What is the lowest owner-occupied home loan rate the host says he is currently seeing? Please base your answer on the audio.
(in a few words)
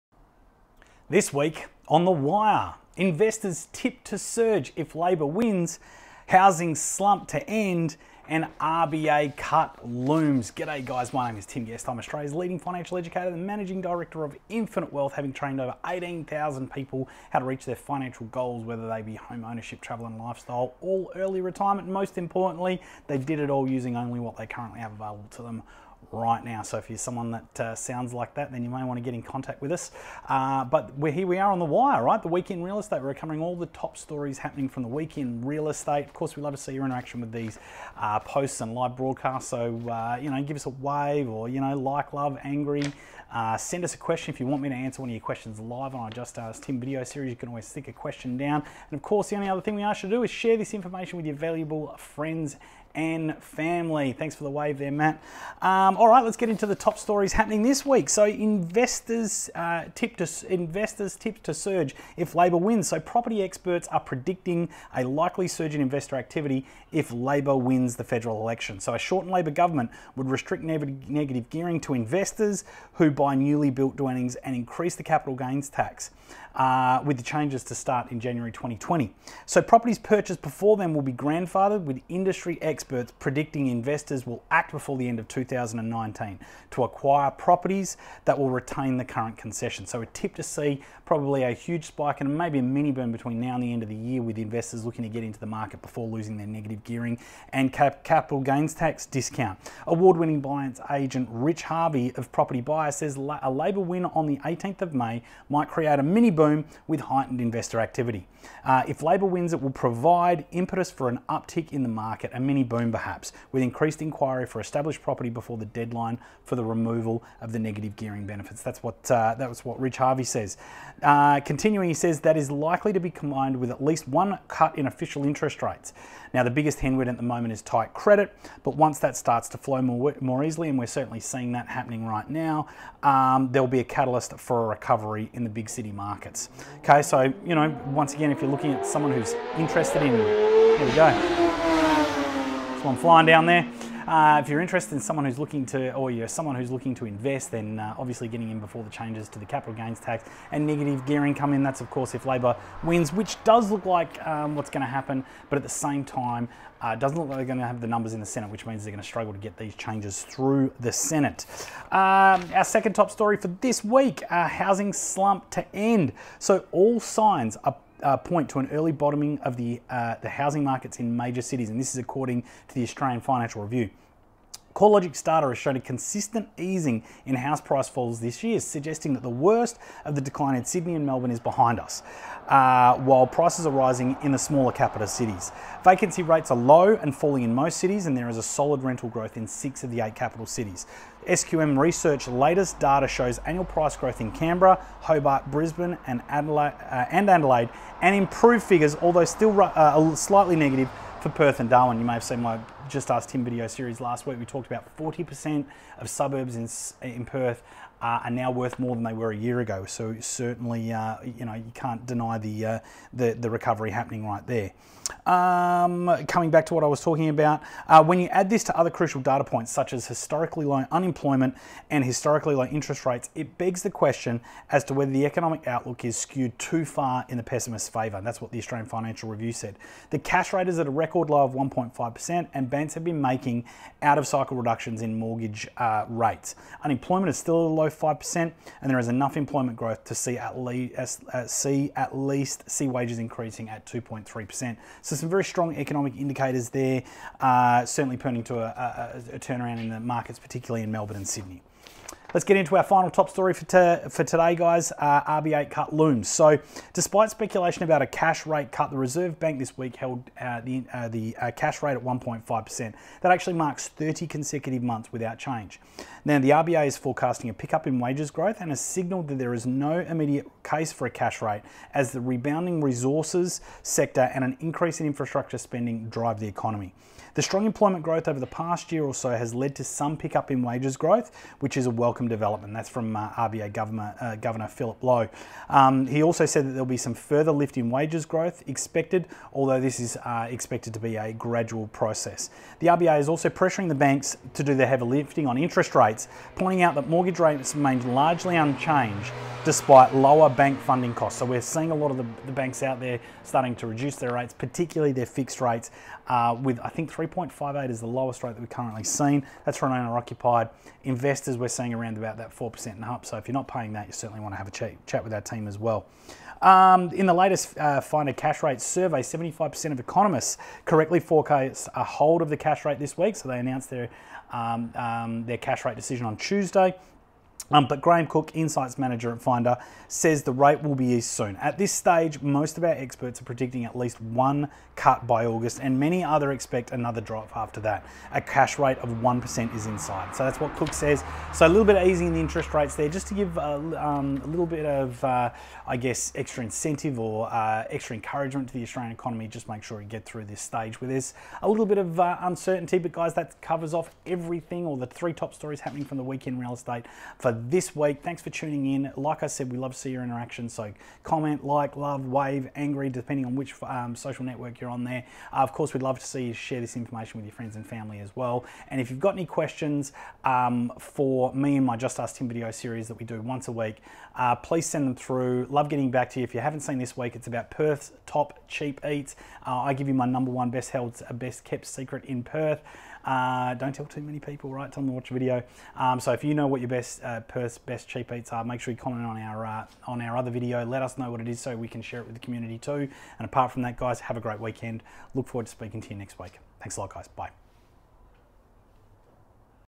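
3.58.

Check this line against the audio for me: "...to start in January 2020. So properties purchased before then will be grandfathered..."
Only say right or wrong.
right.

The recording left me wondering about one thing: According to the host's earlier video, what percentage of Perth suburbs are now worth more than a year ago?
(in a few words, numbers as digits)
40%.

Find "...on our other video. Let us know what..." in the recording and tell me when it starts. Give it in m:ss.
6:30.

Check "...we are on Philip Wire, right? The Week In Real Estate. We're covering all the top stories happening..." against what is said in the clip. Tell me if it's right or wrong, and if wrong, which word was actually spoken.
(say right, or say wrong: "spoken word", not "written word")
wrong: "The", not "Philip".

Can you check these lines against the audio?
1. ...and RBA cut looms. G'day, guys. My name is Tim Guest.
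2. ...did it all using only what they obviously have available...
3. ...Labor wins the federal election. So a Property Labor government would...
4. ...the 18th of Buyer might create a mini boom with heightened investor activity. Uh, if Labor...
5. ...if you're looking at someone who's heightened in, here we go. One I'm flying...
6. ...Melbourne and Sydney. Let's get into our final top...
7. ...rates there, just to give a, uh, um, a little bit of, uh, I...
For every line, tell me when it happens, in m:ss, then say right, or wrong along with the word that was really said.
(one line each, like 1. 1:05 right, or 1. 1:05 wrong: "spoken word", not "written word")
1. 0:08 right
2. 0:23 wrong: "currently", not "obviously"
3. 1:07 wrong: "Shorten", not "Property"
4. 1:44 wrong: "May", not "Buyer"
5. 2:18 wrong: "interested", not "heightened"
6. 4:10 right
7. 5:42 right.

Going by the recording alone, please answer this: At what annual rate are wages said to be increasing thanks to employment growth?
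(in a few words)
2.3%.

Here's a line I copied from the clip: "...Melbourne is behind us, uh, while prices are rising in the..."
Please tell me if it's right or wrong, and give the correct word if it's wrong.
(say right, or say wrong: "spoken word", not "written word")
right.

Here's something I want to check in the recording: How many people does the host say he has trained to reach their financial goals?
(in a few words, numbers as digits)
18,000.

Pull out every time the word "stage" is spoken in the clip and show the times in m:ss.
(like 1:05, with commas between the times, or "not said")
5:31, 5:50.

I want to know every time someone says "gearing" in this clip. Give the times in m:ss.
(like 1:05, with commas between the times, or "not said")
1:11, 1:36, 1:57, 2:31.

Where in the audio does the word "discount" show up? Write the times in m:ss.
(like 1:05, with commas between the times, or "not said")
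1:39.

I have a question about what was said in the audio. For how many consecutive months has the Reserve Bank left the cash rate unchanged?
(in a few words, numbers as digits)
30.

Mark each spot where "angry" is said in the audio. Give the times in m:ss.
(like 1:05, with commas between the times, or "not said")
0:42, 6:02.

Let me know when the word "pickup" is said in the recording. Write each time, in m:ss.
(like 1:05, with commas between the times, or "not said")
4:27, 4:40.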